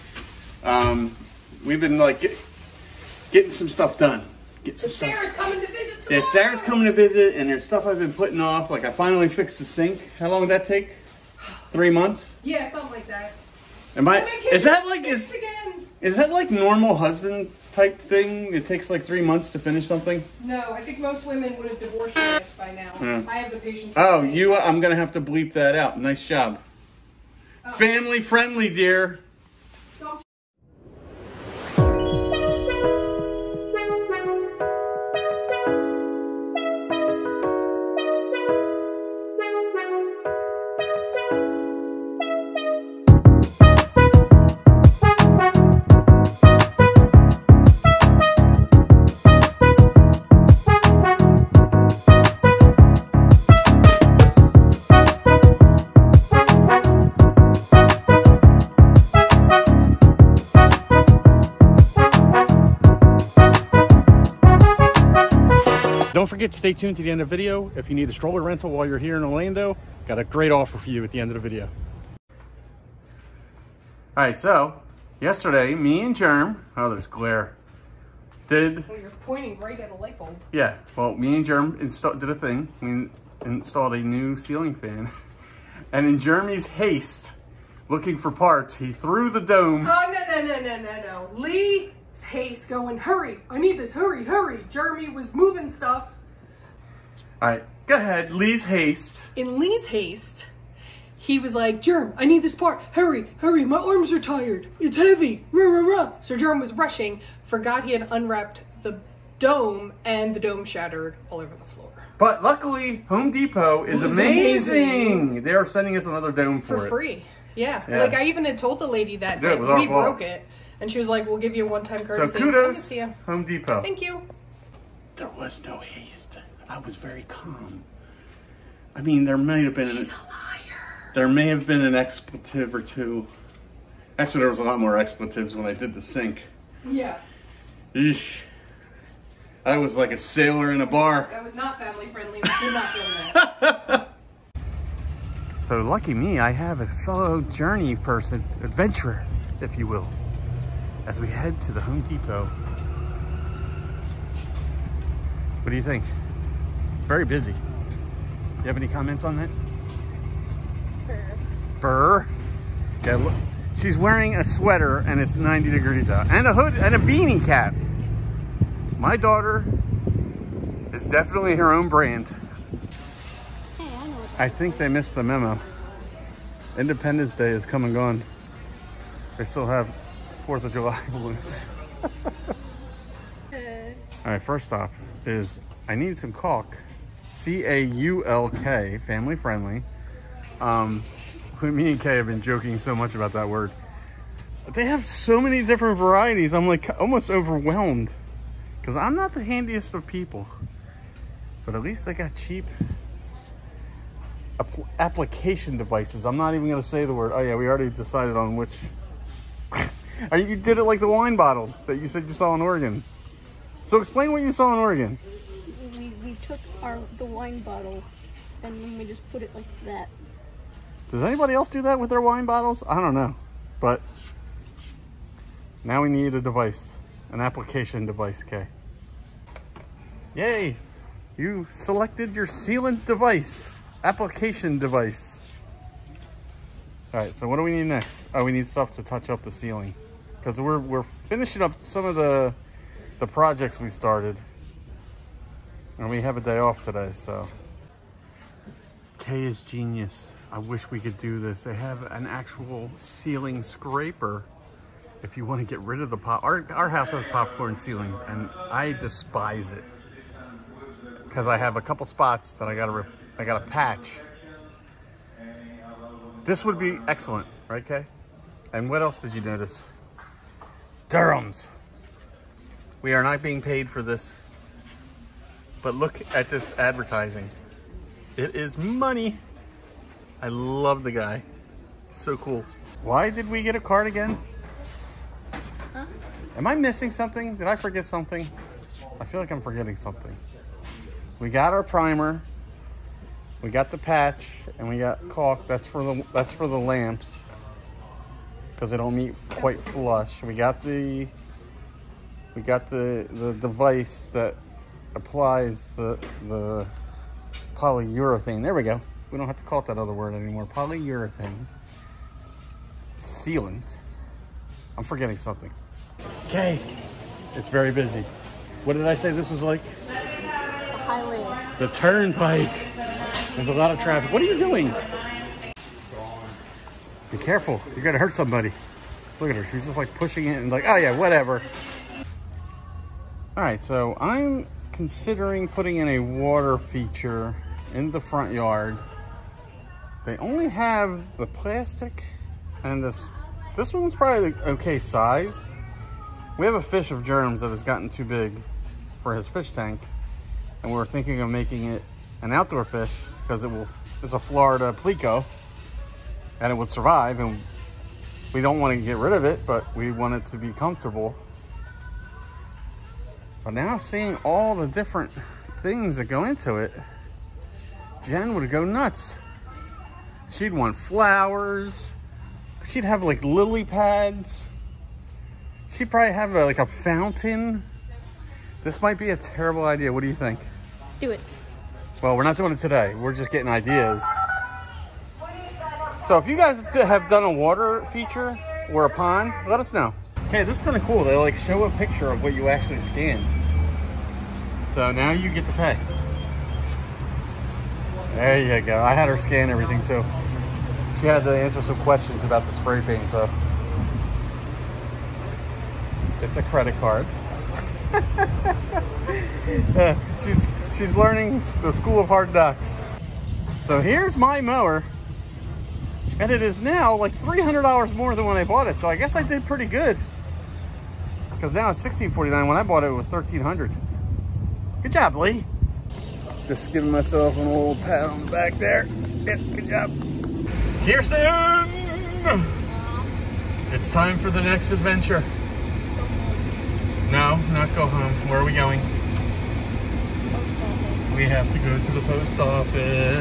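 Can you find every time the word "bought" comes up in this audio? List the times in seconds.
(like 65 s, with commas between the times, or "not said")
418 s, 422 s.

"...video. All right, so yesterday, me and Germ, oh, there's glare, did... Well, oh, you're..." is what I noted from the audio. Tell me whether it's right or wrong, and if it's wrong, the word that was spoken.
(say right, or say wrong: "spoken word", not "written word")
right.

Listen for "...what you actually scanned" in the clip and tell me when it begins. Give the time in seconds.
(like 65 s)
392 s.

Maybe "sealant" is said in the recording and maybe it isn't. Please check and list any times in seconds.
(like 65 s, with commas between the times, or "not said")
232 s, 313 s.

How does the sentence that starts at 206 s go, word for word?
I'm not even going to say the word.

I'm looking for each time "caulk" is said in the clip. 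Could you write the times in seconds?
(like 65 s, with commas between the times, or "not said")
186 s, 295 s.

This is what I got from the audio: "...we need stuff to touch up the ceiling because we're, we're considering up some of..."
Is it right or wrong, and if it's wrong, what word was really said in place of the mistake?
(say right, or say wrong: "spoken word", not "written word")
wrong: "finishing", not "considering".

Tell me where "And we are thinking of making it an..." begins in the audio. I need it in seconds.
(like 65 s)
350 s.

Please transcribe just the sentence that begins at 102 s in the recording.
Hurry, hurry, my arms are tired.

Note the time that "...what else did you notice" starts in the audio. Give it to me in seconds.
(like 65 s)
268 s.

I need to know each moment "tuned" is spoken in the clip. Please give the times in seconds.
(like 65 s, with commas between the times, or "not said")
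66 s.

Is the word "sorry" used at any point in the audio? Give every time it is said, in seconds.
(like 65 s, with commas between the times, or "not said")
not said.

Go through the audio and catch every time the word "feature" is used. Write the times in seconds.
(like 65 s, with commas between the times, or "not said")
336 s, 388 s.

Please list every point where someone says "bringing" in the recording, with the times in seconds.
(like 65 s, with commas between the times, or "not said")
not said.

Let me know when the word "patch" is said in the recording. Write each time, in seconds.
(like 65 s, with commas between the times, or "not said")
263 s, 293 s.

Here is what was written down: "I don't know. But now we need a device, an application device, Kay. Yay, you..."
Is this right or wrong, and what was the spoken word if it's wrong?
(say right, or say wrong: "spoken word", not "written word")
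right.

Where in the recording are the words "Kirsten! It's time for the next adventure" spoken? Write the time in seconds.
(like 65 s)
431 s.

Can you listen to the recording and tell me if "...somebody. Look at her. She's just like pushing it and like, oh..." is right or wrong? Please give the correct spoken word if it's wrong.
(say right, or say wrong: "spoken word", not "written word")
right.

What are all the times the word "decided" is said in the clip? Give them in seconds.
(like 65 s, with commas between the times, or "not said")
207 s.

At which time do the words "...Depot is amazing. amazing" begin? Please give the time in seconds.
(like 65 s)
113 s.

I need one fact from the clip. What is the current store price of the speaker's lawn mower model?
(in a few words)
$1,649.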